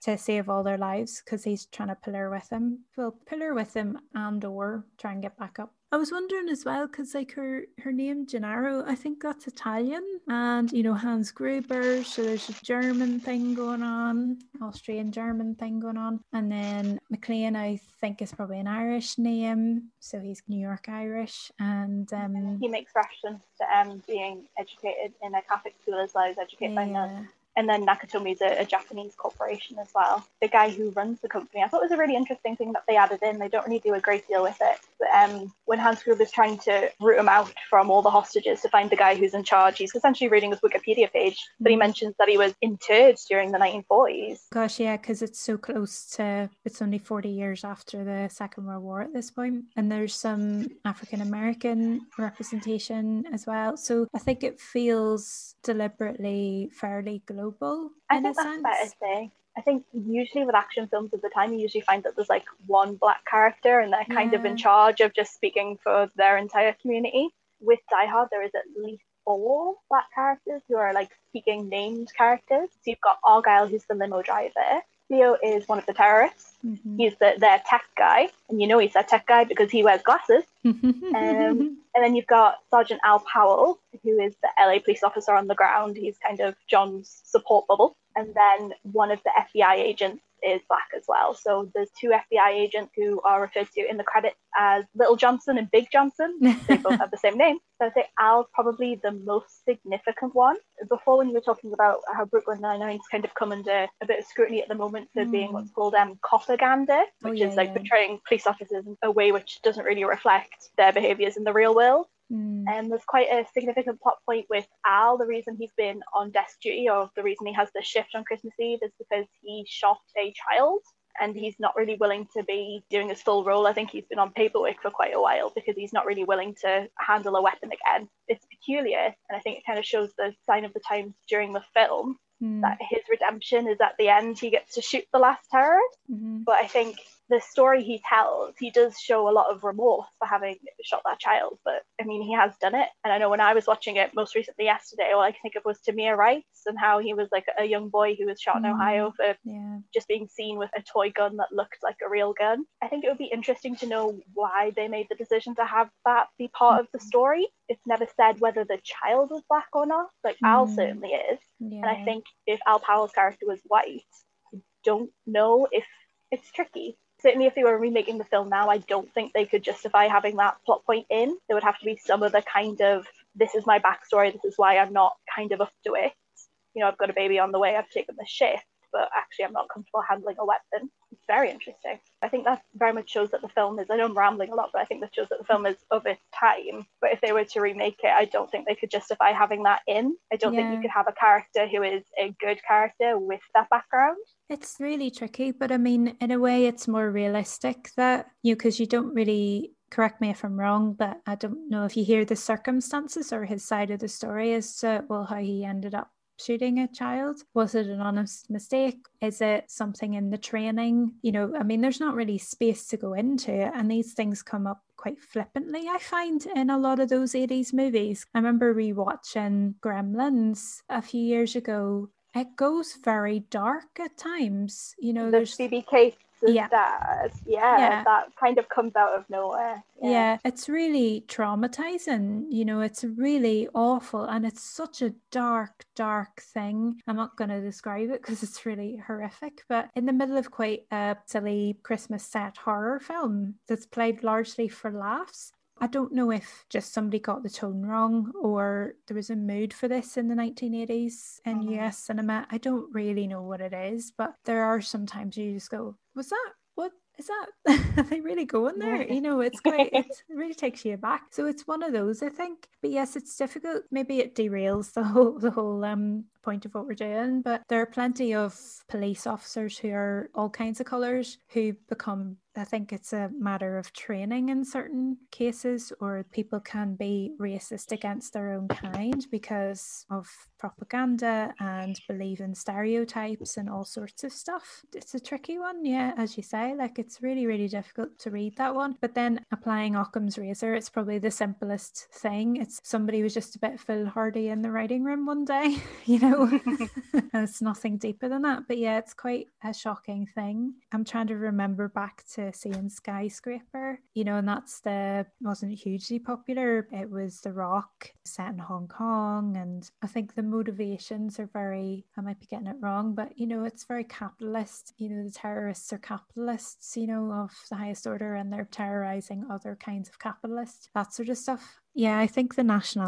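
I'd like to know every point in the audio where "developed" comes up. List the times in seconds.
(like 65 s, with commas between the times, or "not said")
not said.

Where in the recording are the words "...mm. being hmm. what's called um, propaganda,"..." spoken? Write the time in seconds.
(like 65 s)
105 s.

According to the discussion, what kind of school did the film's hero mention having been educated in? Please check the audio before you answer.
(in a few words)
Catholic school.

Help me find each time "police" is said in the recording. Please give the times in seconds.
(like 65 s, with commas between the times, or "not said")
84 s, 108 s, 268 s.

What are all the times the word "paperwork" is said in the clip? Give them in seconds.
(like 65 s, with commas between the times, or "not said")
124 s.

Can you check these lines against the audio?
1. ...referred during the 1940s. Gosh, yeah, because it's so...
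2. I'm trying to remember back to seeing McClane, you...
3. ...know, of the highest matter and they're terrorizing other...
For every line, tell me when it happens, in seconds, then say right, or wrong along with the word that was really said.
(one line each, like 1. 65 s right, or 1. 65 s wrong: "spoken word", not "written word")
1. 42 s wrong: "interred", not "referred"
2. 300 s wrong: "Skyscraper", not "McClane"
3. 317 s wrong: "order", not "matter".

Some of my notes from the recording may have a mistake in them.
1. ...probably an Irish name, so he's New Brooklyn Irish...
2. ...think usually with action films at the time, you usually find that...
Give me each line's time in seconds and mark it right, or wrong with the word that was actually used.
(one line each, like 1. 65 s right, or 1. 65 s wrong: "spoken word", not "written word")
1. 18 s wrong: "York", not "Brooklyn"
2. 59 s right.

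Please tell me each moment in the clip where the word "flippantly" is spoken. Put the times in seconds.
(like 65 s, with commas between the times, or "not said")
215 s.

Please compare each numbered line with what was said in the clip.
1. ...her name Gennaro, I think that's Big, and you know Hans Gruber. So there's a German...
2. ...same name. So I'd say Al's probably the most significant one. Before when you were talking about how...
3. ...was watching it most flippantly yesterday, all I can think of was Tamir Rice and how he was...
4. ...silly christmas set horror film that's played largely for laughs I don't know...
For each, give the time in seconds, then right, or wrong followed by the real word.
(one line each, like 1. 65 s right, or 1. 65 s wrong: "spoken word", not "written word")
1. 7 s wrong: "Italian", not "Big"
2. 97 s right
3. 143 s wrong: "recently", not "flippantly"
4. 241 s right.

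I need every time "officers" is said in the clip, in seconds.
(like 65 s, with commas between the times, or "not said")
85 s, 108 s, 269 s.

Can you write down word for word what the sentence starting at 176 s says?
You know, I've got a baby on the way, I've taken the shift but actually I'm not comfortable handling a weapon.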